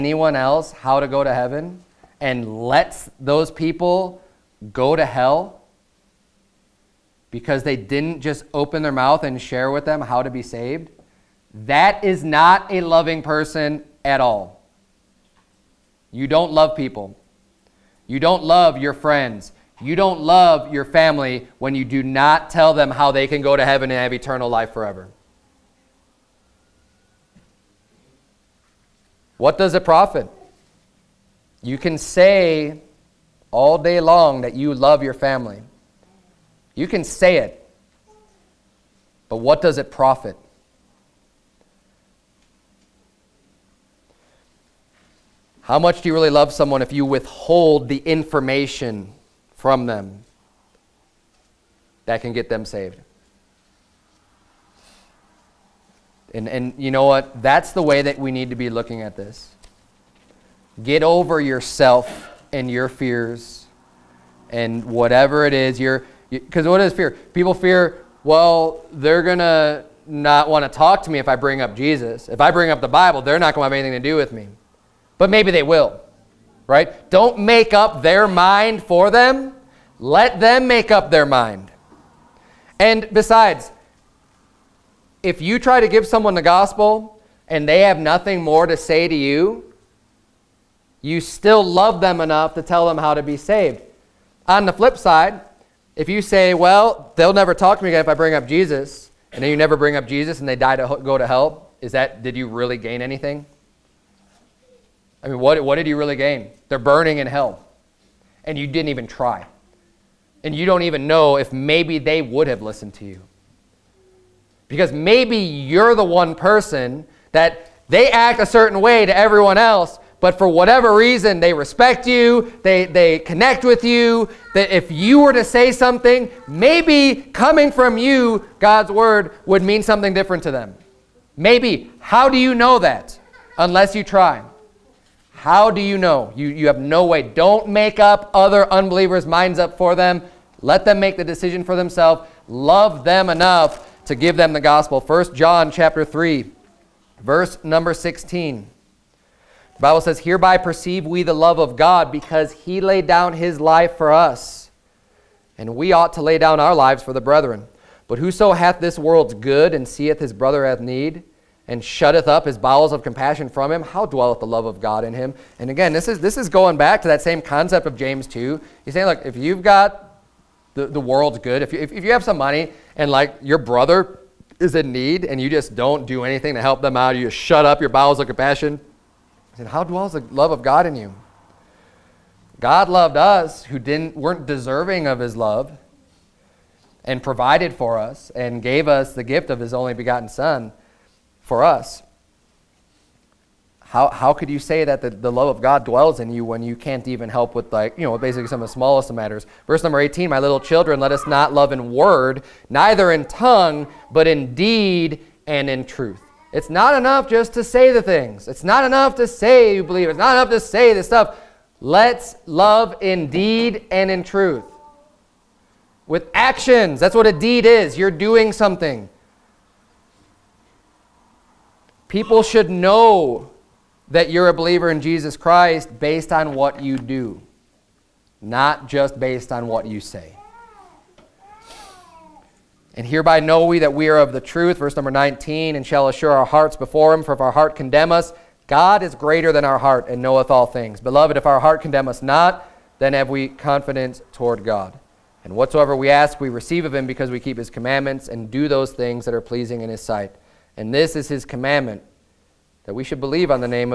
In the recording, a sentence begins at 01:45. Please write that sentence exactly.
I mean, what, what did you really gain?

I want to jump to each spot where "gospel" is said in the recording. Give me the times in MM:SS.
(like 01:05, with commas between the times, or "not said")
01:26, 02:24.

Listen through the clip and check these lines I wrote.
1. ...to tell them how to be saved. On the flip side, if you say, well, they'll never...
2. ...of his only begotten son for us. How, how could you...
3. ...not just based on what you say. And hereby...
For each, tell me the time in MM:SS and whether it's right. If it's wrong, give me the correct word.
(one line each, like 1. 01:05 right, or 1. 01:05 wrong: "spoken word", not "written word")
1. 01:32 right
2. 03:09 right
3. 03:48 right.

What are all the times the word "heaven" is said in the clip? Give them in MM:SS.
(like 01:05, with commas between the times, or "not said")
00:01, 00:23.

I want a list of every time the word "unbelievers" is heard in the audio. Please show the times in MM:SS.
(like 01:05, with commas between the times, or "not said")
02:18.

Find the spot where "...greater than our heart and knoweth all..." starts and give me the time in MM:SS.
03:59.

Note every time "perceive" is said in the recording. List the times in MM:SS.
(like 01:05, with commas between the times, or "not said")
02:30.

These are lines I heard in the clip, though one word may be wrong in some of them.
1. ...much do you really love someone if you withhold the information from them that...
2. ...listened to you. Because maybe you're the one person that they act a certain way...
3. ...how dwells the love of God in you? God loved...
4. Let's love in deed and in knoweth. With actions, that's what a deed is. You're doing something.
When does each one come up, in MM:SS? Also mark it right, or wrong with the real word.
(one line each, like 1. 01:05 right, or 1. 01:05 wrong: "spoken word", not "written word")
1. 00:45 right
2. 01:52 right
3. 02:59 right
4. 03:31 wrong: "truth", not "knoweth".